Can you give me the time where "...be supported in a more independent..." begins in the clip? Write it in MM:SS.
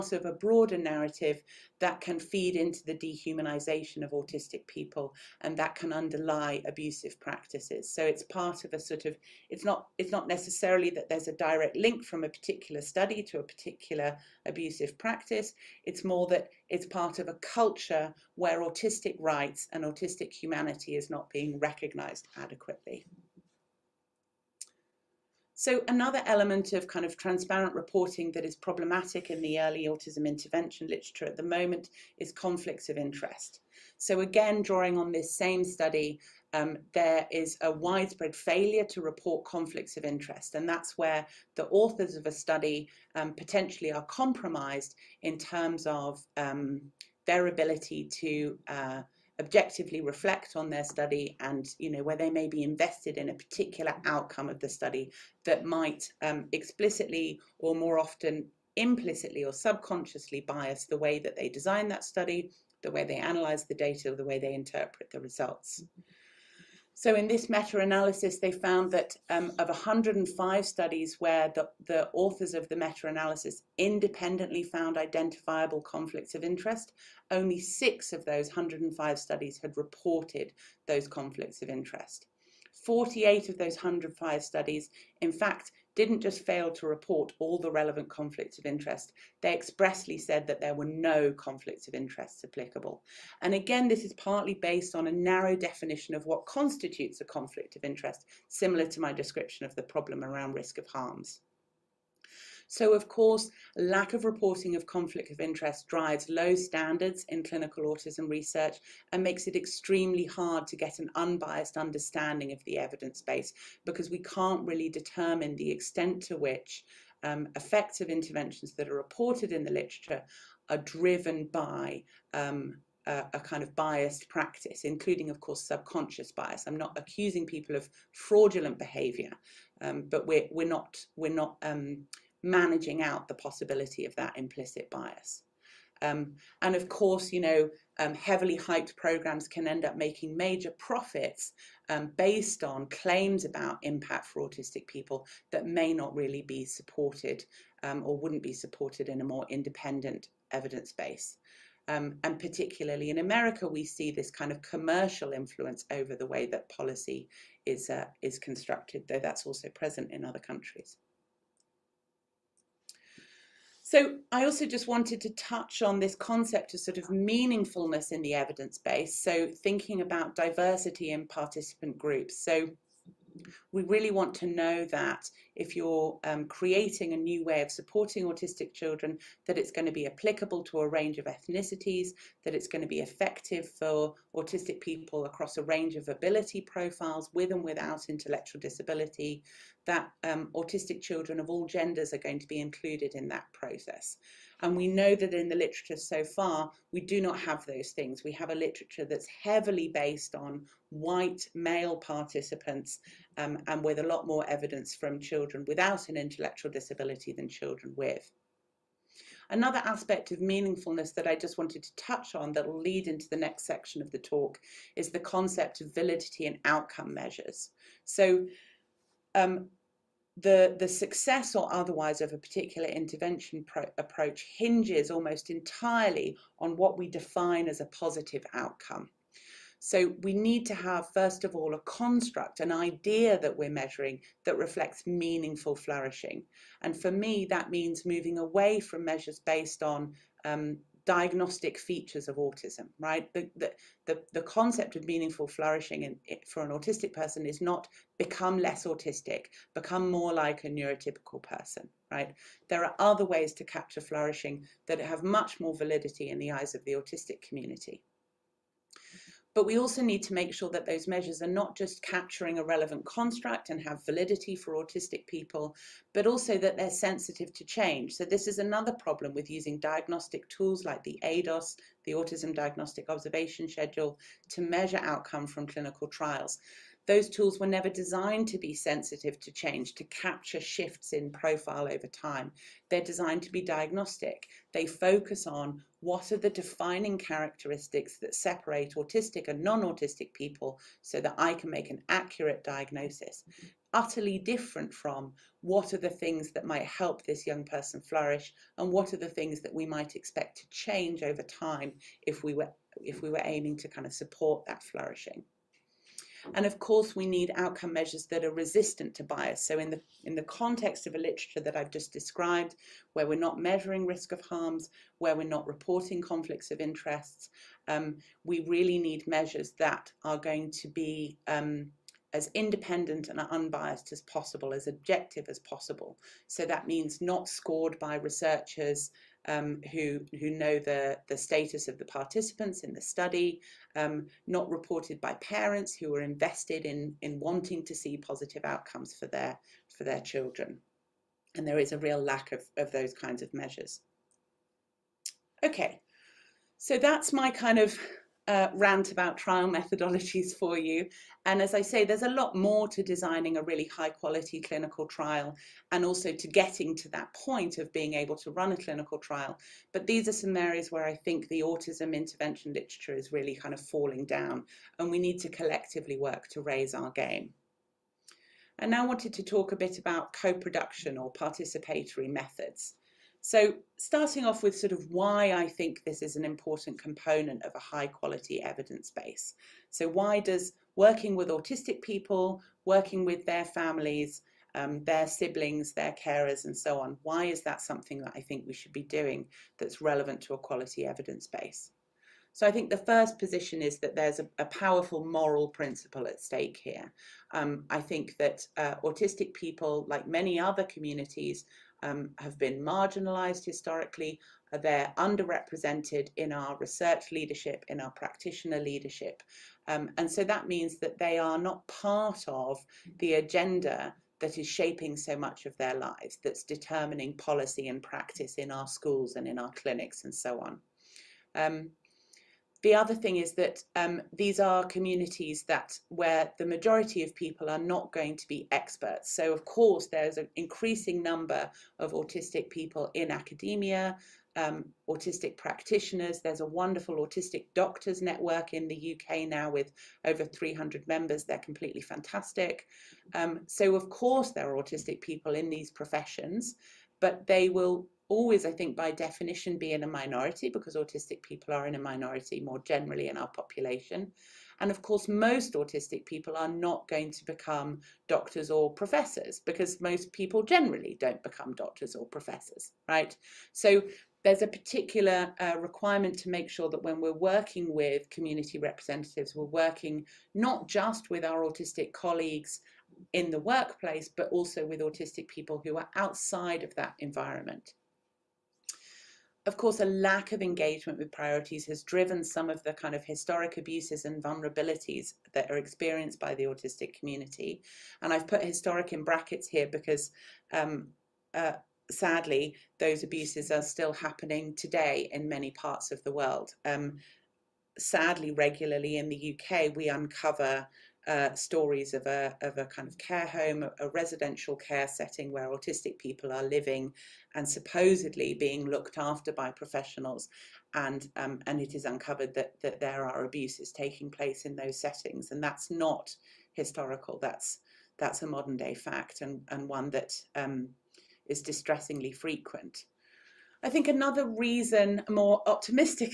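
02:28.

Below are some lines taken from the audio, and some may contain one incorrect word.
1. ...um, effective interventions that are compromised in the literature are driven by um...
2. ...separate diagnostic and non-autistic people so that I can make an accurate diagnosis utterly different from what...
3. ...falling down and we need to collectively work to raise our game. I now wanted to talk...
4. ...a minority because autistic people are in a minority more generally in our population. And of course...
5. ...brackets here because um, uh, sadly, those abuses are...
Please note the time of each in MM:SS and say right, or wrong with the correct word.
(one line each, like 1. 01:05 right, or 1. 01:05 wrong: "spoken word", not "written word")
1. 01:57 wrong: "reported", not "compromised"
2. 04:48 wrong: "autistic", not "diagnostic"
3. 06:03 right
4. 07:30 right
5. 08:09 right.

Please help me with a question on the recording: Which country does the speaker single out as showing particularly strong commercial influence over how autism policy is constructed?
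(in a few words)
America.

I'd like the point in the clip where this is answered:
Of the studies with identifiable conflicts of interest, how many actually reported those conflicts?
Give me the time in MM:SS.
01:17.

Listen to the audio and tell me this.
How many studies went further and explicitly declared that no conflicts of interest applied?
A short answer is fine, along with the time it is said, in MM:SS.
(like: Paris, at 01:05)
48, at 01:22.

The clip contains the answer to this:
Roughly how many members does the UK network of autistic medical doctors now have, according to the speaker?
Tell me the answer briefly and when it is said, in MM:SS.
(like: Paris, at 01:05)
Over 300, at 07:20.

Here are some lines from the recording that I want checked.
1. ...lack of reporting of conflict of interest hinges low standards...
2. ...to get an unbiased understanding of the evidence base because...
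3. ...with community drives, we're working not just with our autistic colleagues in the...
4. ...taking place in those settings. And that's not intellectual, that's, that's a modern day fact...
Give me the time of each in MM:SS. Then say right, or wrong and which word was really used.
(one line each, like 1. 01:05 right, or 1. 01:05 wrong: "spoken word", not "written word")
1. 01:43 wrong: "drives", not "hinges"
2. 01:50 right
3. 07:47 wrong: "representatives", not "drives"
4. 08:33 wrong: "historical", not "intellectual".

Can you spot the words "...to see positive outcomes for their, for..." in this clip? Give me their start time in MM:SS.
05:37.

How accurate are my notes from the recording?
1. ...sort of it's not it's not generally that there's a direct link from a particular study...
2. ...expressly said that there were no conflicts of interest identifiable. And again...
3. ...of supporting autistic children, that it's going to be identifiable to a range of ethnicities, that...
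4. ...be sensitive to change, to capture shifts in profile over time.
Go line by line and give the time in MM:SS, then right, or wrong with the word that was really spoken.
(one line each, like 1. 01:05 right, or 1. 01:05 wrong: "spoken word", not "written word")
1. 00:08 wrong: "necessarily", not "generally"
2. 01:29 wrong: "applicable", not "identifiable"
3. 02:57 wrong: "applicable", not "identifiable"
4. 04:38 right.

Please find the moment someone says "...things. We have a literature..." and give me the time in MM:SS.
03:17.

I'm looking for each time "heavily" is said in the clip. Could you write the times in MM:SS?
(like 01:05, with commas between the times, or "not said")
02:18, 03:19.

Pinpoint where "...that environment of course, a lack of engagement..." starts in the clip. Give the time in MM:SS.
07:56.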